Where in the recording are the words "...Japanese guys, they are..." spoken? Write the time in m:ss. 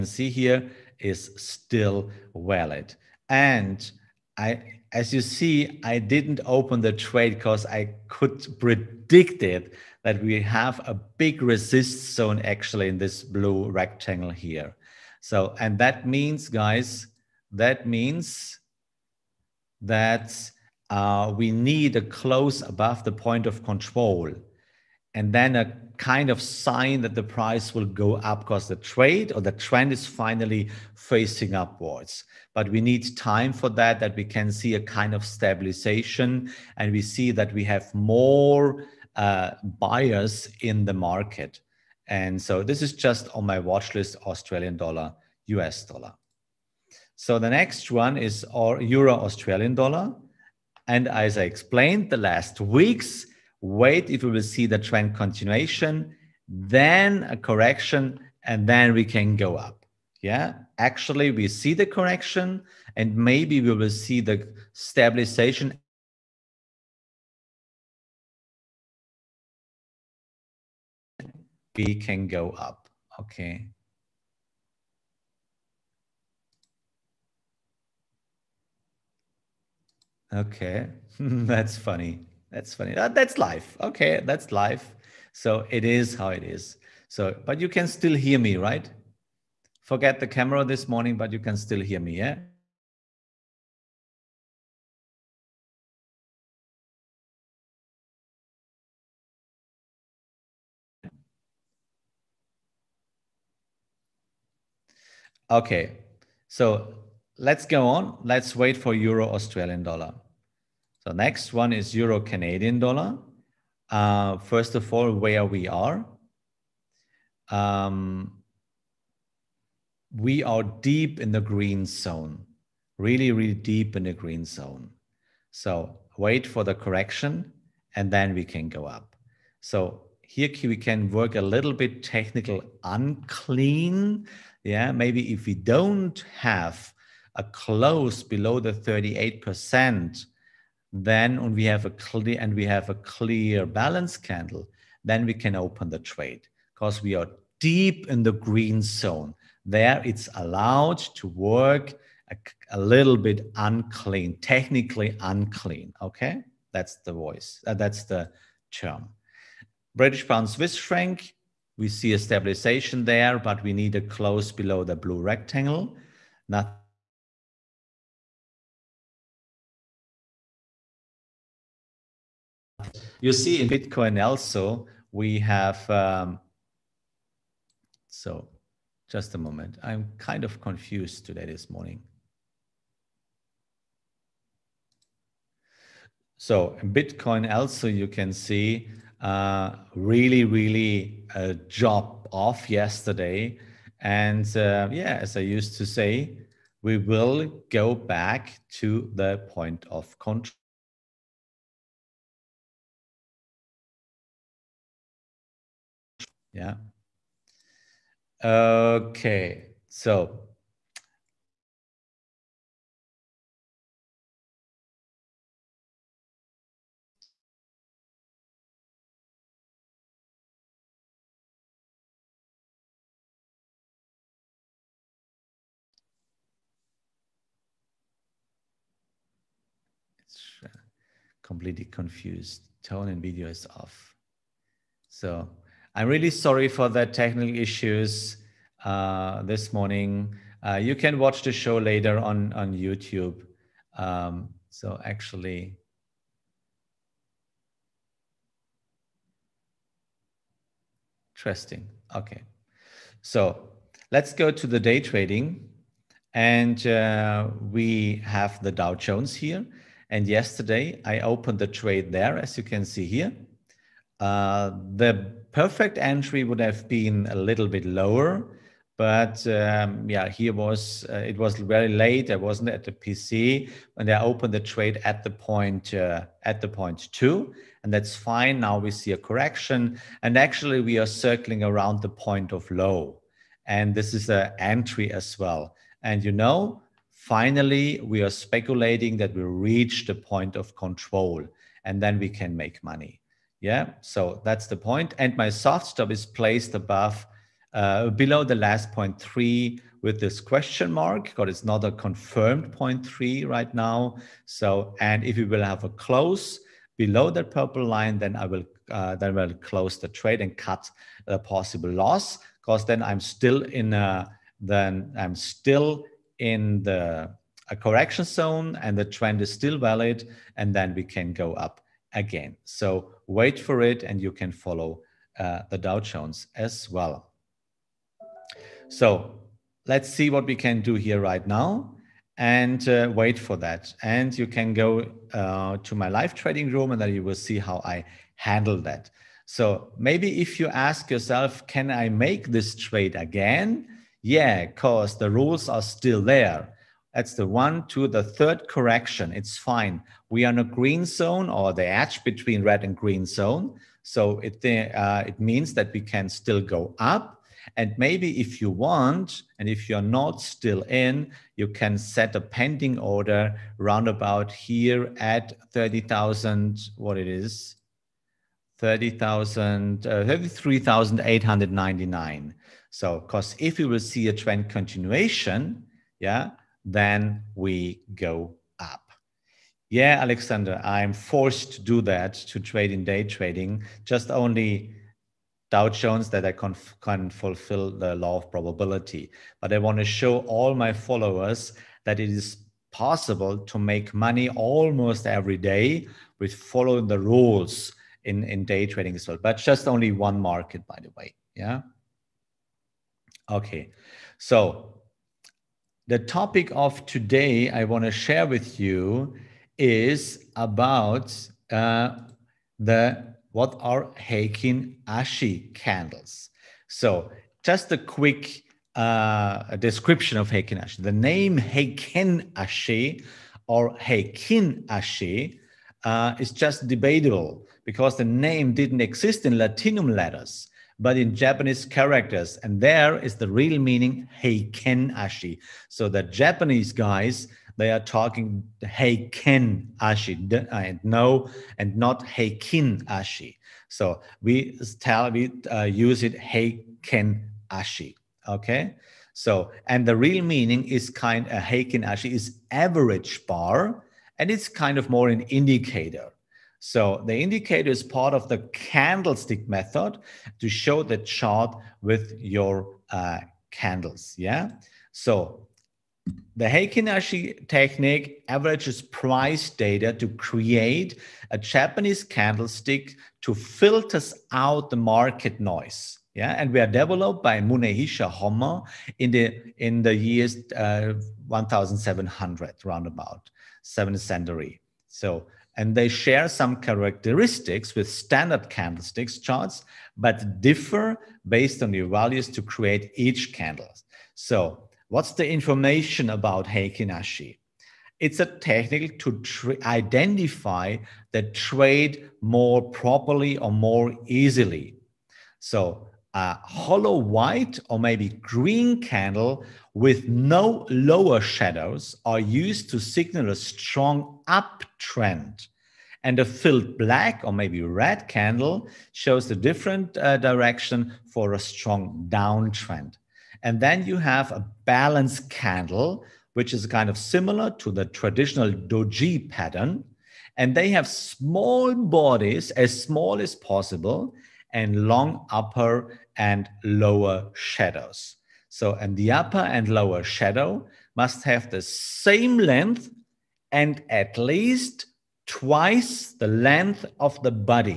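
7:16.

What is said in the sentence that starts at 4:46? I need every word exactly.
And you know, finally we are speculating that we reach the point of control, and then we can make money.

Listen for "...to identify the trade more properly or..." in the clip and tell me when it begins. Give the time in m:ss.
8:19.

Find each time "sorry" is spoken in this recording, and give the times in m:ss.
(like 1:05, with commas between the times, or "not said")
3:56.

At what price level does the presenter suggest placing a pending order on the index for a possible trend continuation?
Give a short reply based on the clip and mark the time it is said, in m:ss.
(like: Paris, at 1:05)
33,899, at 6:10.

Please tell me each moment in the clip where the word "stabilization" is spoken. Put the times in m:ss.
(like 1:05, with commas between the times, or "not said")
0:35, 1:04, 2:42.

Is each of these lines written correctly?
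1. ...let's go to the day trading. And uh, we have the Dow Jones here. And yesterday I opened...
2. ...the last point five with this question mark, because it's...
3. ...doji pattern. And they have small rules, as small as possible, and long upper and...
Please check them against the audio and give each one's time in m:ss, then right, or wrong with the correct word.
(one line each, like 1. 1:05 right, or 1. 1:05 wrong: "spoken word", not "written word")
1. 4:14 right
2. 4:58 wrong: "three", not "five"
3. 8:48 wrong: "bodies", not "rules".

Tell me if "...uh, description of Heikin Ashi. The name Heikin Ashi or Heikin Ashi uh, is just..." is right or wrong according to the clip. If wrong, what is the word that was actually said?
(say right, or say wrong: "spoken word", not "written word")
right.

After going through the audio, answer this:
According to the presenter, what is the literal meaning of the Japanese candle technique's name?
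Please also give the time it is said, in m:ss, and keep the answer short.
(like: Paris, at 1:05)
average bar, at 7:32.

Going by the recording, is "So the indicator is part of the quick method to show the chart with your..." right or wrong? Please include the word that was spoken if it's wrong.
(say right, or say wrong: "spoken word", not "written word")
wrong: "candlestick", not "quick".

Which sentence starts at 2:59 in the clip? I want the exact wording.
I'm kind of confused today this morning.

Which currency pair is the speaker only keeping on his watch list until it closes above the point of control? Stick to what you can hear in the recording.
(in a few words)
Australian dollar, US dollar.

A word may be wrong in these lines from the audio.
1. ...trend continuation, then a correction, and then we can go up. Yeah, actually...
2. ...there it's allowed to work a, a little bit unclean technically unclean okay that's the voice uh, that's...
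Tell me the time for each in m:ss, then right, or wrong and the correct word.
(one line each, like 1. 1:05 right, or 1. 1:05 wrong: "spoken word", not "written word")
1. 0:54 right
2. 2:29 right.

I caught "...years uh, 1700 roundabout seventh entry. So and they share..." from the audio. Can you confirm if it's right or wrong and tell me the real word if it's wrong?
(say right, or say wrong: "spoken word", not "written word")
wrong: "century", not "entry".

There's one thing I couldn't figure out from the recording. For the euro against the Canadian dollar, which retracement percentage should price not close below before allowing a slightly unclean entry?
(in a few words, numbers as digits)
38%.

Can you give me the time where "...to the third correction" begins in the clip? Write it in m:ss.
5:47.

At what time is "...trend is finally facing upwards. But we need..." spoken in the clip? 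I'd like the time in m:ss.
0:29.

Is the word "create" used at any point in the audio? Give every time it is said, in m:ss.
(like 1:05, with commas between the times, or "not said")
7:50, 8:12.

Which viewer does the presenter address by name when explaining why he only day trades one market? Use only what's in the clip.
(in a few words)
Alexander.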